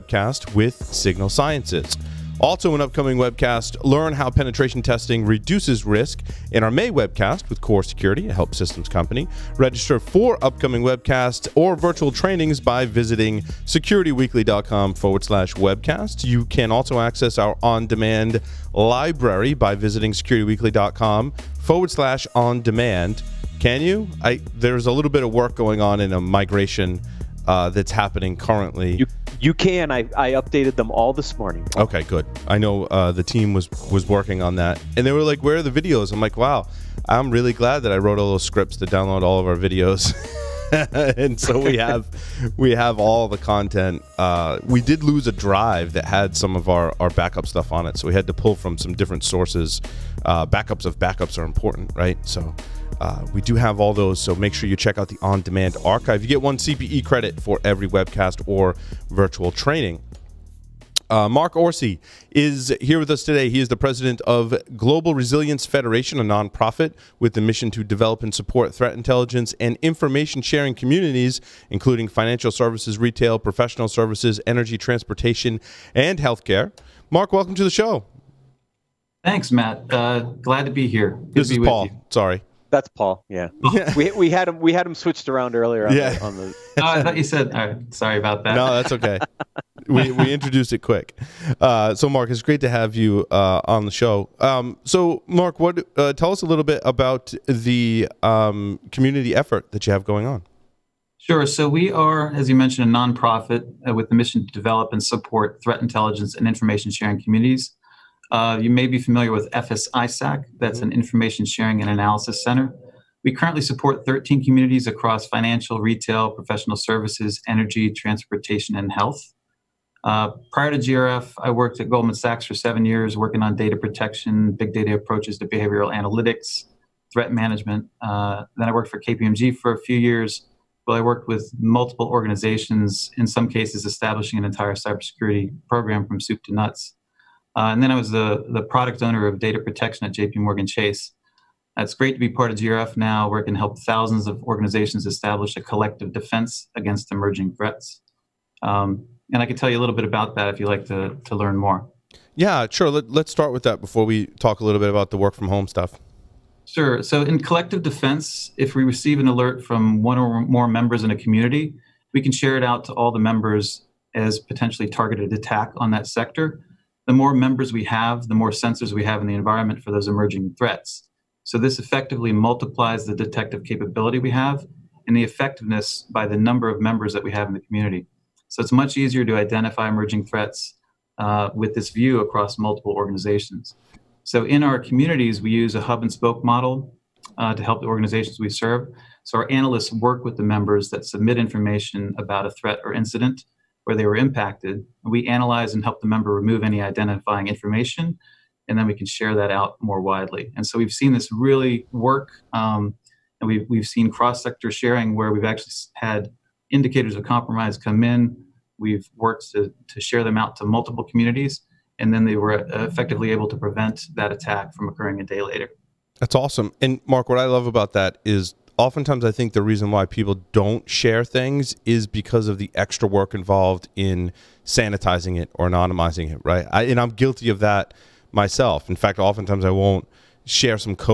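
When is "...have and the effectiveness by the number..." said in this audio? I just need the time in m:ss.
2:54.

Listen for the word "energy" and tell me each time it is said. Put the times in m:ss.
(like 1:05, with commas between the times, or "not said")
1:14, 1:57.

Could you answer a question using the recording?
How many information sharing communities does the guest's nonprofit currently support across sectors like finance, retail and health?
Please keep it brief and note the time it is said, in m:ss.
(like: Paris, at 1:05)
13, at 1:54.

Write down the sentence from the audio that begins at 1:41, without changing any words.
So we are, as you mentioned, a nonprofit uh, with the mission to develop and support threat intelligence and information sharing communities.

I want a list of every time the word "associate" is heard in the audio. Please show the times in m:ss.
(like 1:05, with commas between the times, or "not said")
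not said.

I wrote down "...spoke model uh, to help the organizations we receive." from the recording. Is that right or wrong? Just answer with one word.
wrong.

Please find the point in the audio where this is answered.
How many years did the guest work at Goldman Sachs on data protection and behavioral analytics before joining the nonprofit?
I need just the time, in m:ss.
2:02.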